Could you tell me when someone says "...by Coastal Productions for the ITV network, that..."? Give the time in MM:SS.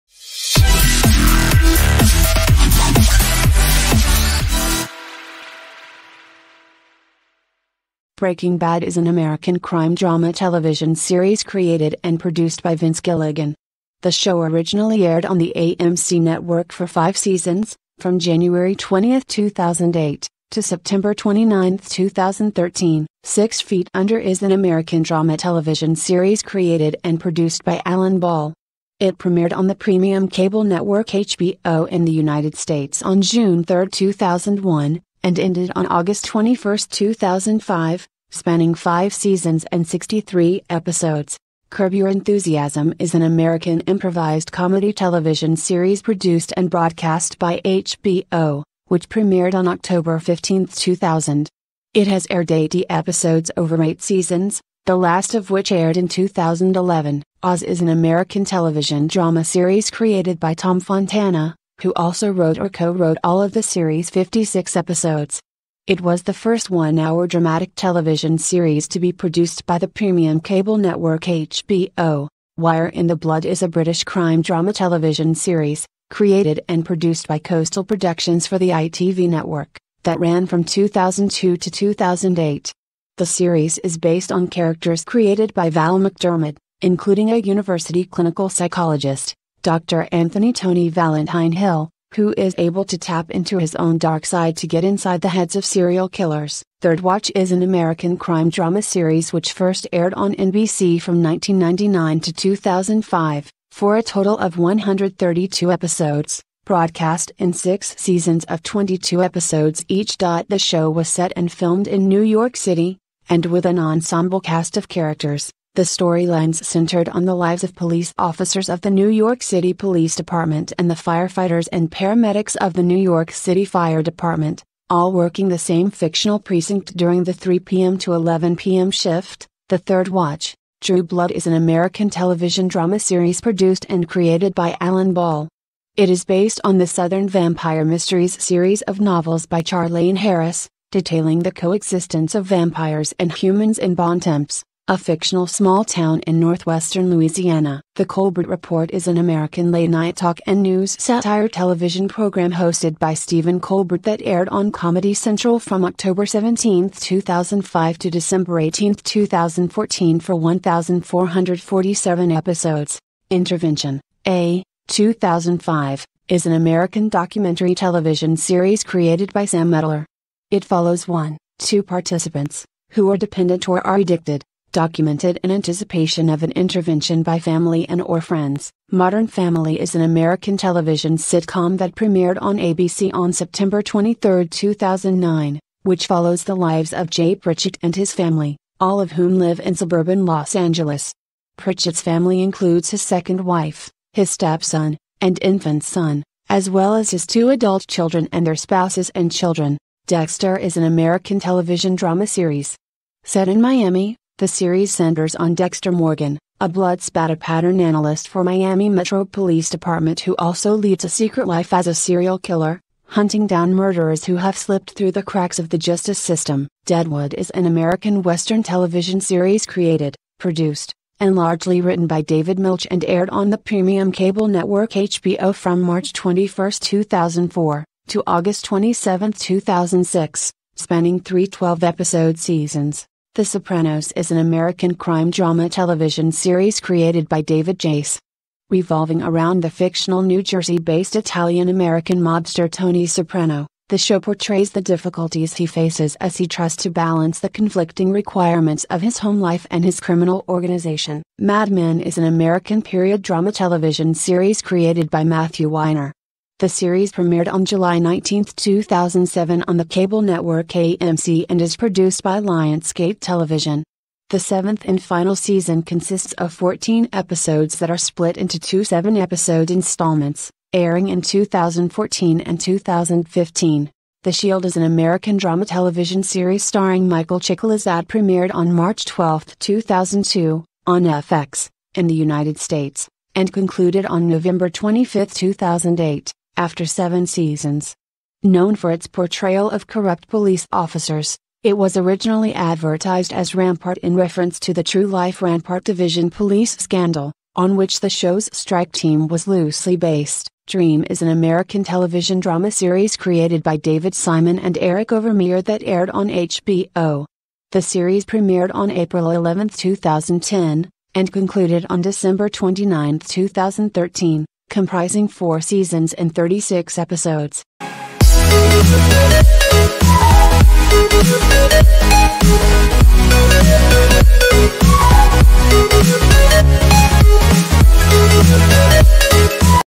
01:17.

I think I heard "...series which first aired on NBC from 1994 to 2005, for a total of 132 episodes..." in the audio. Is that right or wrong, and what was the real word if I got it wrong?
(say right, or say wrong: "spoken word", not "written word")
wrong: "1999", not "1994".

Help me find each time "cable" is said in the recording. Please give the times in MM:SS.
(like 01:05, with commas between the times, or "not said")
00:30, 01:10, 03:44, 04:19.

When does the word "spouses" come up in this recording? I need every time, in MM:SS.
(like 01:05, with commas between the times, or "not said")
03:18.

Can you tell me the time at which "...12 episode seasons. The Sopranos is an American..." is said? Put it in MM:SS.
03:51.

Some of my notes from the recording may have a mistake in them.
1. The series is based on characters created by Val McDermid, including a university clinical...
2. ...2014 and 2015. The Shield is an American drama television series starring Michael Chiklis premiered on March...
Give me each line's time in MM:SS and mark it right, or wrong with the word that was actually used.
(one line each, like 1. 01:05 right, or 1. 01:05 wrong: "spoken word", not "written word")
1. 01:23 right
2. 04:31 right.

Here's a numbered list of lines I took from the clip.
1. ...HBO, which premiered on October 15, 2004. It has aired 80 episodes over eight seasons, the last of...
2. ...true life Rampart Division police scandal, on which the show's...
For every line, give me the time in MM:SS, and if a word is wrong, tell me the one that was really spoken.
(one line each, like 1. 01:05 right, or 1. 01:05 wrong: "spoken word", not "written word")
1. 00:47 wrong: "2000", not "2004"
2. 04:54 right.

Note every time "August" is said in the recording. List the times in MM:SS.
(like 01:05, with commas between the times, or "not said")
00:35, 03:48.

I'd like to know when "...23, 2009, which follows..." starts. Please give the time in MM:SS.
03:03.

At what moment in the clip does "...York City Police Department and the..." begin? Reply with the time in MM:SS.
01:59.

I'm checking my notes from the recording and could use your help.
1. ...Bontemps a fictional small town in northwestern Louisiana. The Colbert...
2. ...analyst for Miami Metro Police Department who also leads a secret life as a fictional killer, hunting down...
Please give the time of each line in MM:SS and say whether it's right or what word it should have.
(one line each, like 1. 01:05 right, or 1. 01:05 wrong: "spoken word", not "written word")
1. 02:23 right
2. 03:27 wrong: "serial", not "fictional".